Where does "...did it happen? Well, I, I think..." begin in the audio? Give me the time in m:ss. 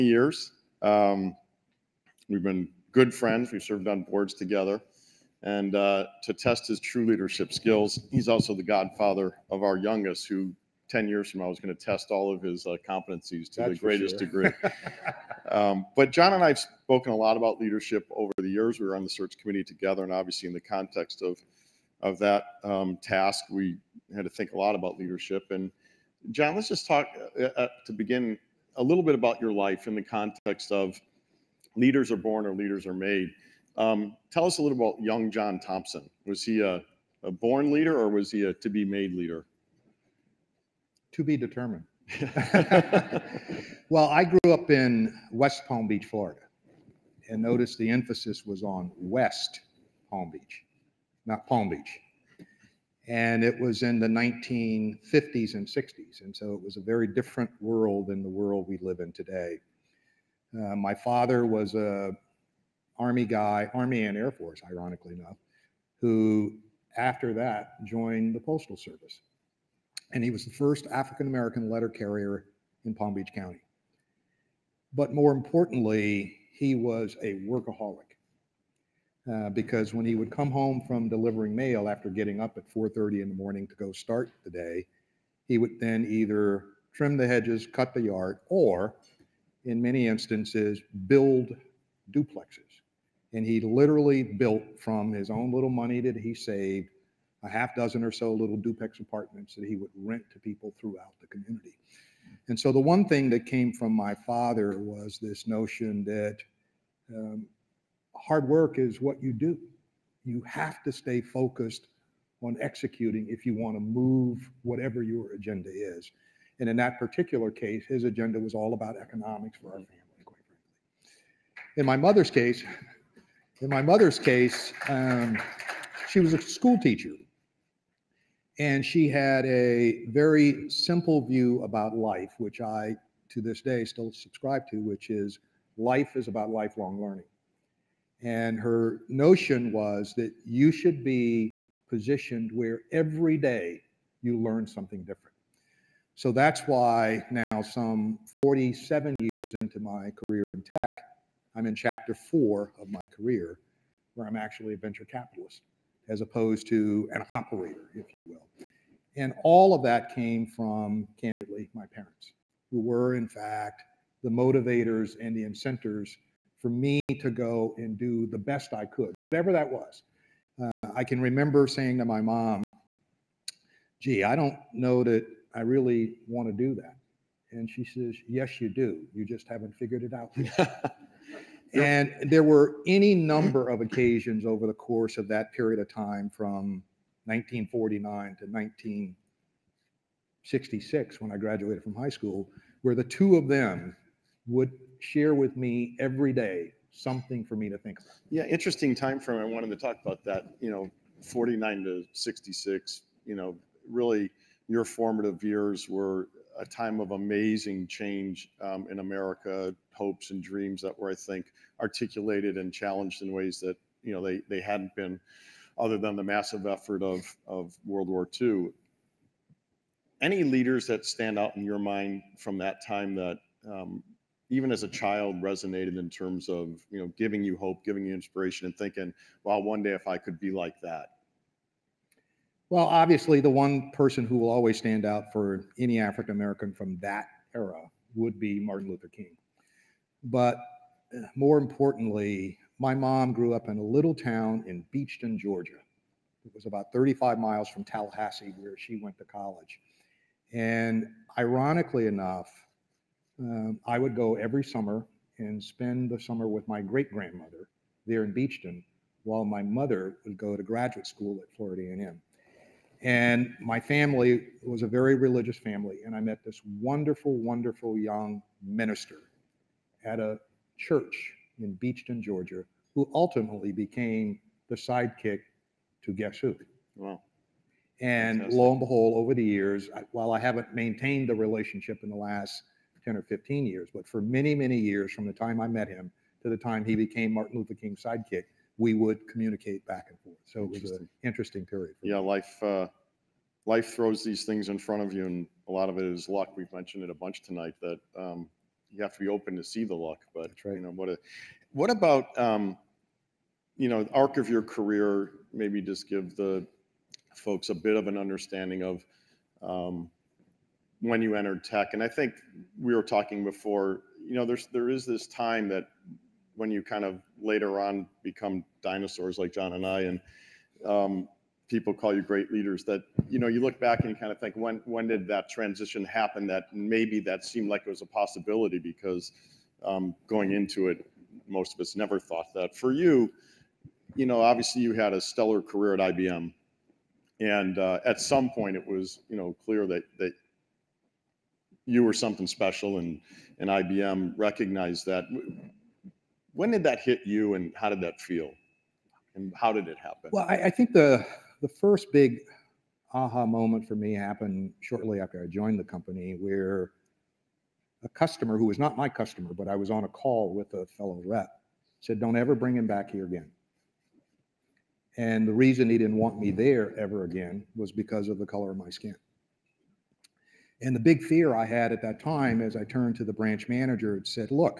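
5:49.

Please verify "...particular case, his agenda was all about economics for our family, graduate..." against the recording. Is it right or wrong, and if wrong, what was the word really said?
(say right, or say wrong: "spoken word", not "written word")
wrong: "quite", not "graduate".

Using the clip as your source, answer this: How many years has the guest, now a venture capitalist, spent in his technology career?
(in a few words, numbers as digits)
47.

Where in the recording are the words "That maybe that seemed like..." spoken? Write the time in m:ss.
5:26.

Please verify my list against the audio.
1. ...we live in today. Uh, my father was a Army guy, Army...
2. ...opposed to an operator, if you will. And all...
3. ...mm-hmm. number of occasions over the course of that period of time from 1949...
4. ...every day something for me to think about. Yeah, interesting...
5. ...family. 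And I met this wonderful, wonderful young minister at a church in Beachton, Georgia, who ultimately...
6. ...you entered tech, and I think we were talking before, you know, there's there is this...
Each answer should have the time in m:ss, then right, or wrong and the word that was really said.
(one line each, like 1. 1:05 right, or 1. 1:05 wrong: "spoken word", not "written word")
1. 0:58 right
2. 2:36 right
3. 3:03 right
4. 3:15 right
5. 4:25 right
6. 5:11 right.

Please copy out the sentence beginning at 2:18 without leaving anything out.
And her notion was that you should be positioned where every day you learn something different.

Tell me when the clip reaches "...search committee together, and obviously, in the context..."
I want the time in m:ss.
0:19.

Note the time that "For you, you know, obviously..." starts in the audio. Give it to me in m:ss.
5:32.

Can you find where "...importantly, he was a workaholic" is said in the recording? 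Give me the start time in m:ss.
1:15.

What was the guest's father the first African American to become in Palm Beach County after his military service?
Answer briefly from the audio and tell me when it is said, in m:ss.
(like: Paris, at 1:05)
Letter carrier, at 1:11.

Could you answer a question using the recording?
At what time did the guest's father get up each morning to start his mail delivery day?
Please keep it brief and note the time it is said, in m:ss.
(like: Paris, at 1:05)
4:30, at 1:22.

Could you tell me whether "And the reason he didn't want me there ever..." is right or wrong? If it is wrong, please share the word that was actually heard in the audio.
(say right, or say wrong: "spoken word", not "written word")
right.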